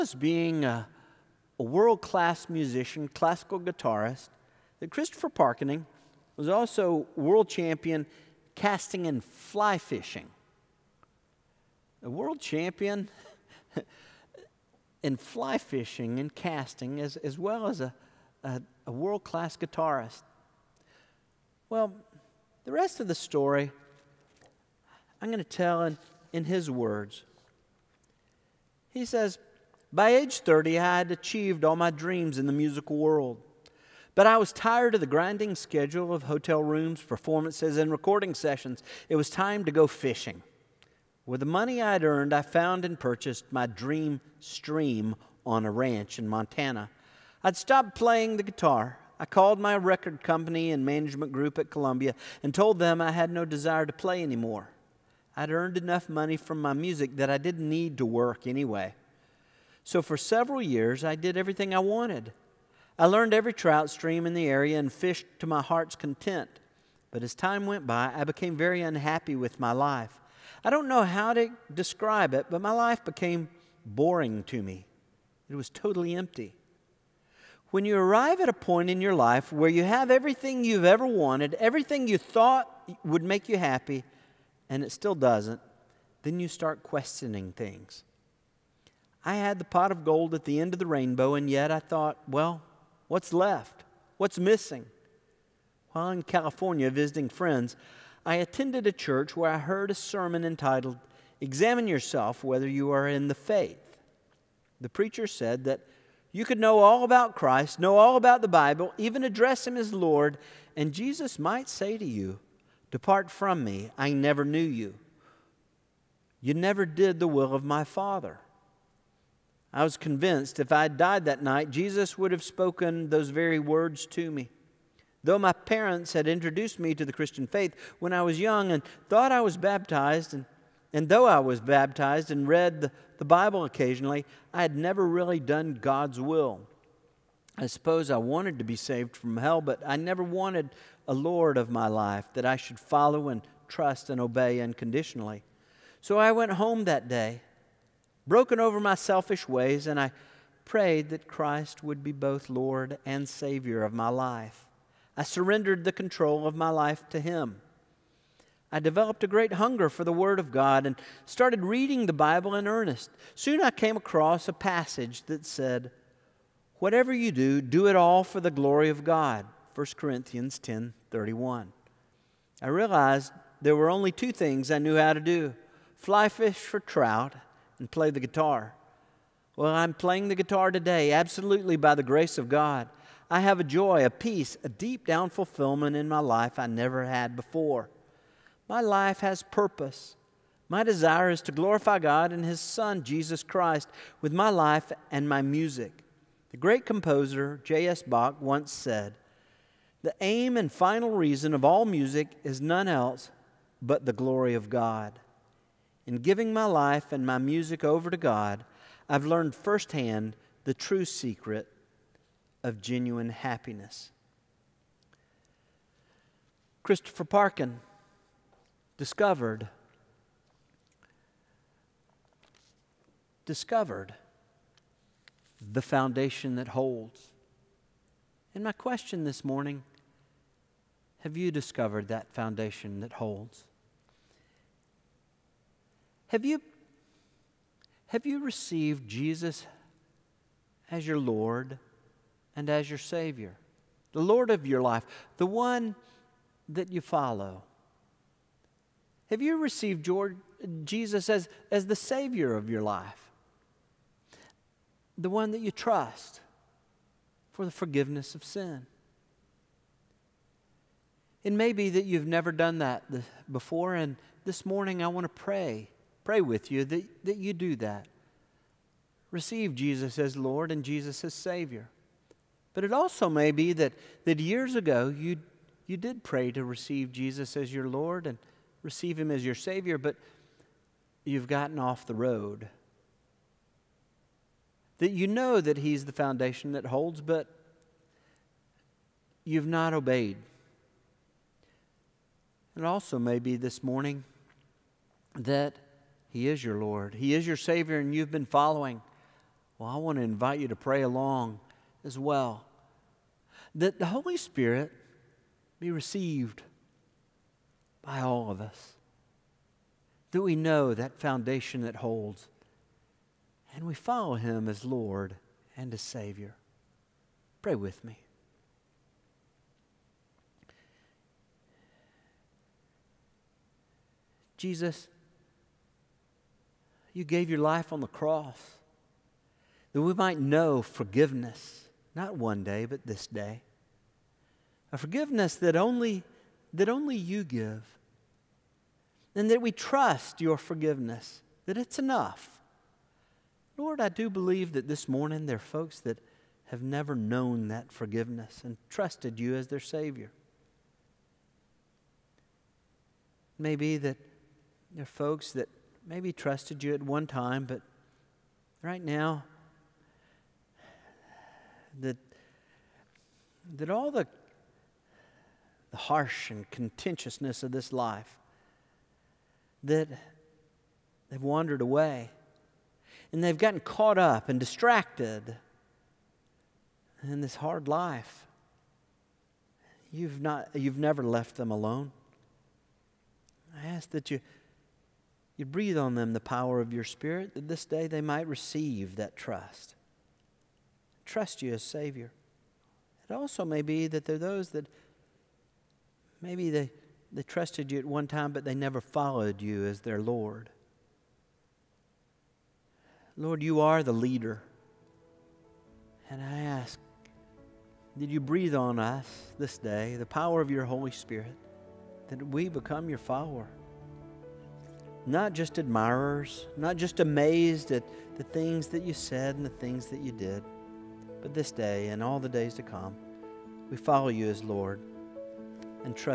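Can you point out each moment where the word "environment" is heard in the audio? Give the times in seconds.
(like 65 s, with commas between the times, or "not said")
not said.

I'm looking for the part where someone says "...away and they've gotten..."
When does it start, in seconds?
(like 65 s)
371 s.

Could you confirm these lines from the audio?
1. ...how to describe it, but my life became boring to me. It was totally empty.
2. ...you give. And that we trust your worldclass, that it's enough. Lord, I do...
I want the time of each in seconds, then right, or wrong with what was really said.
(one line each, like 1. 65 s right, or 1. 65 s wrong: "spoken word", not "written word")
1. 71 s right
2. 337 s wrong: "forgiveness", not "worldclass".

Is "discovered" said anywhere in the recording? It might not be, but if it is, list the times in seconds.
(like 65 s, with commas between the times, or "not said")
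218 s, 223 s, 231 s.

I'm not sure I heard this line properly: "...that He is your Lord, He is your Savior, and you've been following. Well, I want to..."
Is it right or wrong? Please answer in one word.
right.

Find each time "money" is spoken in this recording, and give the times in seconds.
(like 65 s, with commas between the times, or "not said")
41 s, 56 s.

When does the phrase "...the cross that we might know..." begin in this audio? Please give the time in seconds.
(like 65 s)
328 s.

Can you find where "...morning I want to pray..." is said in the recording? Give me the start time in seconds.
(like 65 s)
264 s.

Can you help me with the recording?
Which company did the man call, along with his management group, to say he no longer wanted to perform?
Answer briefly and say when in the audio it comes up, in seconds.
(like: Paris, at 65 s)
Columbia, at 51 s.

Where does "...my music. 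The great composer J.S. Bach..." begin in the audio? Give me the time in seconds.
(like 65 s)
195 s.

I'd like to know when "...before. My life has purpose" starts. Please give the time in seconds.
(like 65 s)
187 s.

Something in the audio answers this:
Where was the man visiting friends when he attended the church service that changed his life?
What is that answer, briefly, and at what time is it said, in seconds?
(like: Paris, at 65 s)
California, at 96 s.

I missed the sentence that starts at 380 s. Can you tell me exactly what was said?
You've, not, you've never left them alone.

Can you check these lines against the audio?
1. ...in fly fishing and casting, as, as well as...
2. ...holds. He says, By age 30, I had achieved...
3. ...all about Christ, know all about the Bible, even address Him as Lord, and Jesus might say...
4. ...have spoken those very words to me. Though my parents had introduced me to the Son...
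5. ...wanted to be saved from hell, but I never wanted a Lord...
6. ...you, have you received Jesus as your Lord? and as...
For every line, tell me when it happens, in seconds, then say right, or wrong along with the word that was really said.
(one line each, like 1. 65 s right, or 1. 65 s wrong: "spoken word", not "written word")
1. 15 s right
2. 26 s wrong: "words", not "holds"
3. 106 s right
4. 122 s wrong: "Christian", not "Son"
5. 138 s right
6. 236 s right.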